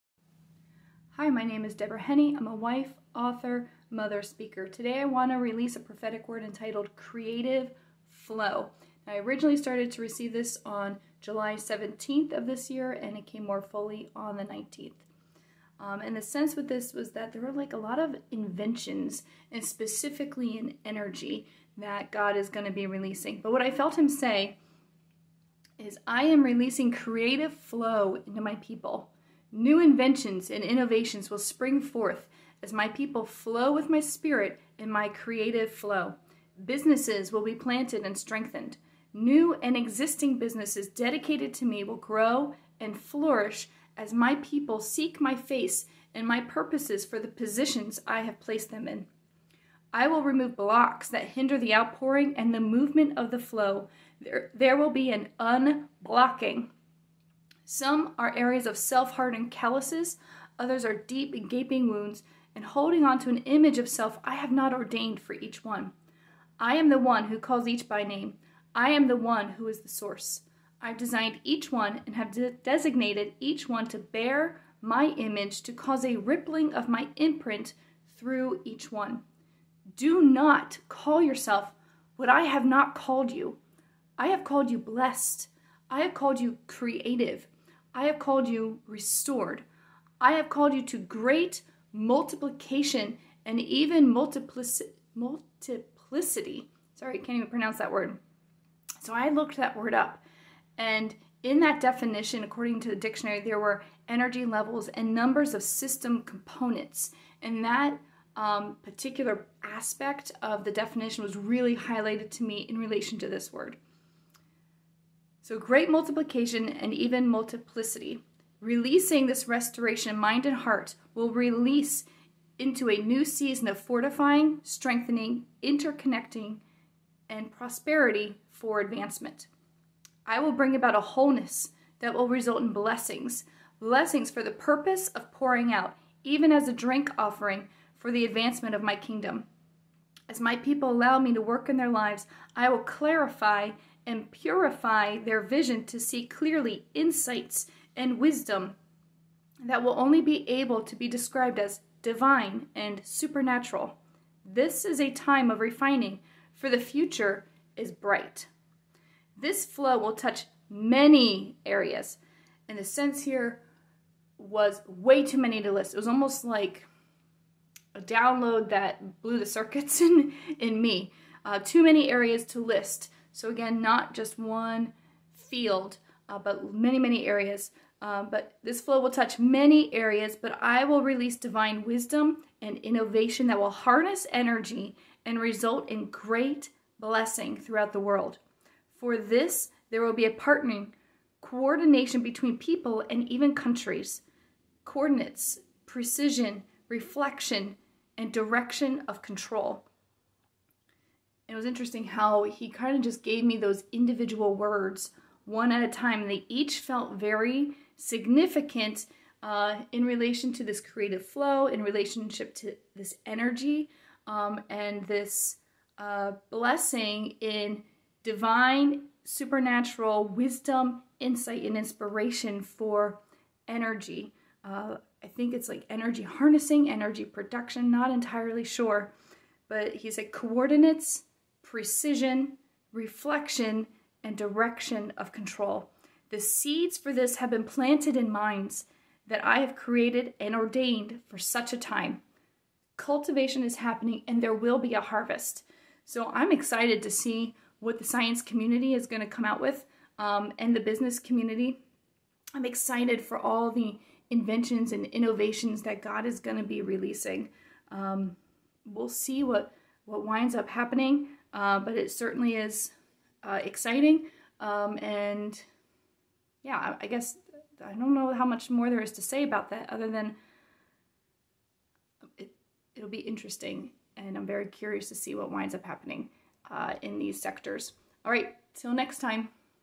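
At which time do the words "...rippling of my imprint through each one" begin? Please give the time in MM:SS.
01:16.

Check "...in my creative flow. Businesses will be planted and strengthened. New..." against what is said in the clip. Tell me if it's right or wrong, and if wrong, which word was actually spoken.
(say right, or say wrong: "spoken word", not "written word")
right.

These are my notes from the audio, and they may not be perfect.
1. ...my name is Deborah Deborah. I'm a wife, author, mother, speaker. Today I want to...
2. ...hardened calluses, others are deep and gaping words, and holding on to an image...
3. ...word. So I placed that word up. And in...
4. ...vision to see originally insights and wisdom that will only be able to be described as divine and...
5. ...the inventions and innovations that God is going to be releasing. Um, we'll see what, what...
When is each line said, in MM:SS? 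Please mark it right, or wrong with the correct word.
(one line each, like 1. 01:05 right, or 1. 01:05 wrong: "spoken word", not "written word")
1. 00:01 wrong: "Henne", not "Deborah"
2. 00:59 wrong: "wounds", not "words"
3. 01:37 wrong: "looked", not "placed"
4. 02:25 wrong: "clearly", not "originally"
5. 04:13 right.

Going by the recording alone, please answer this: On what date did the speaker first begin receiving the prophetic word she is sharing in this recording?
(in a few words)
July 17th.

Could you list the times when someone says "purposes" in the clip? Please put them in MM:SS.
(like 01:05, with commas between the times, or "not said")
00:46, 02:14.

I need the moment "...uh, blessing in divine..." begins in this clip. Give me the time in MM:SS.
03:35.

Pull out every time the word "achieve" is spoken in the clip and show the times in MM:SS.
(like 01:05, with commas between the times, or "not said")
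not said.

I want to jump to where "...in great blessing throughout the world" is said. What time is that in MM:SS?
03:05.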